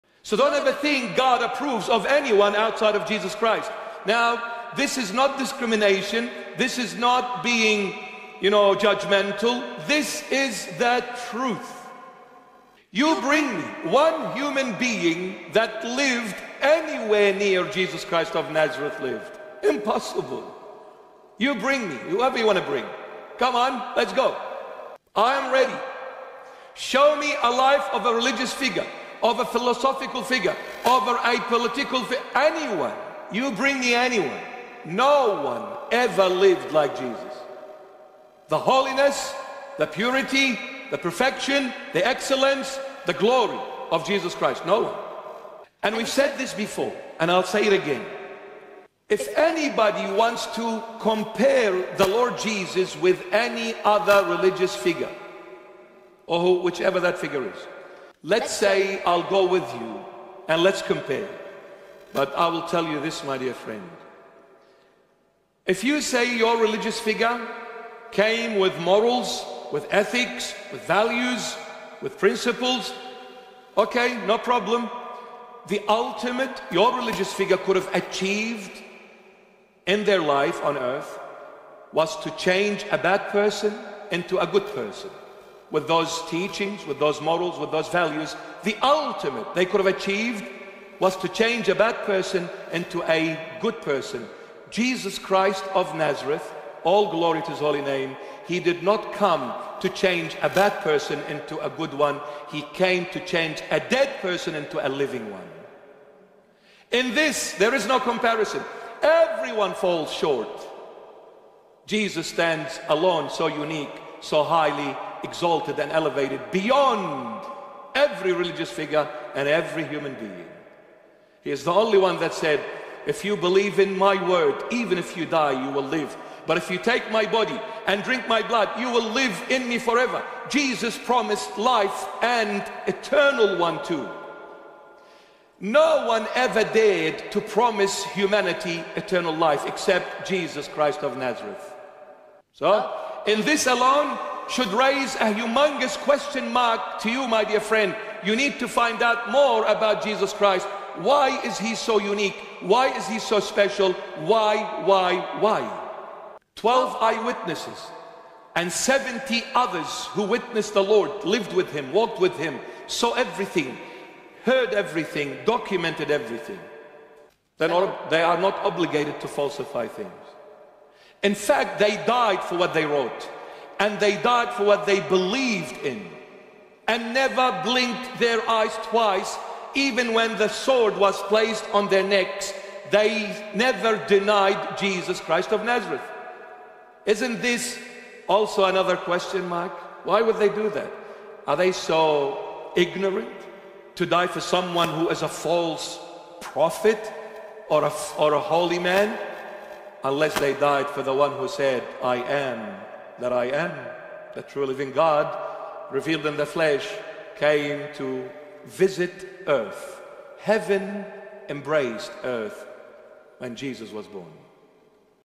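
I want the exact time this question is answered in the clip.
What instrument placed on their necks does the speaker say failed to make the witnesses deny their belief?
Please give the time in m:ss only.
3:00.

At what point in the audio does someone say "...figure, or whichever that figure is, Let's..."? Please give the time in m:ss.
0:54.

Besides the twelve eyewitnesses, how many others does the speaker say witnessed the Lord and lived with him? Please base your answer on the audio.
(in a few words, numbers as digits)
70.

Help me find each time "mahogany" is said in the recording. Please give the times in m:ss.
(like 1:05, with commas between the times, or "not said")
not said.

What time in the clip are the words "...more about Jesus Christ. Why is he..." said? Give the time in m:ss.
2:29.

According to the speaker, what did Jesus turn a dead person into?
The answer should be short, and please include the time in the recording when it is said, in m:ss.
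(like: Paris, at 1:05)
A living one, at 1:44.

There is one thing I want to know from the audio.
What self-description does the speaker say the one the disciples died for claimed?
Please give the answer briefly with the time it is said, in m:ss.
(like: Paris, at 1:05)
I am that I am, at 3:22.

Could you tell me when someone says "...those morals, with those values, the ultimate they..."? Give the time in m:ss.
1:26.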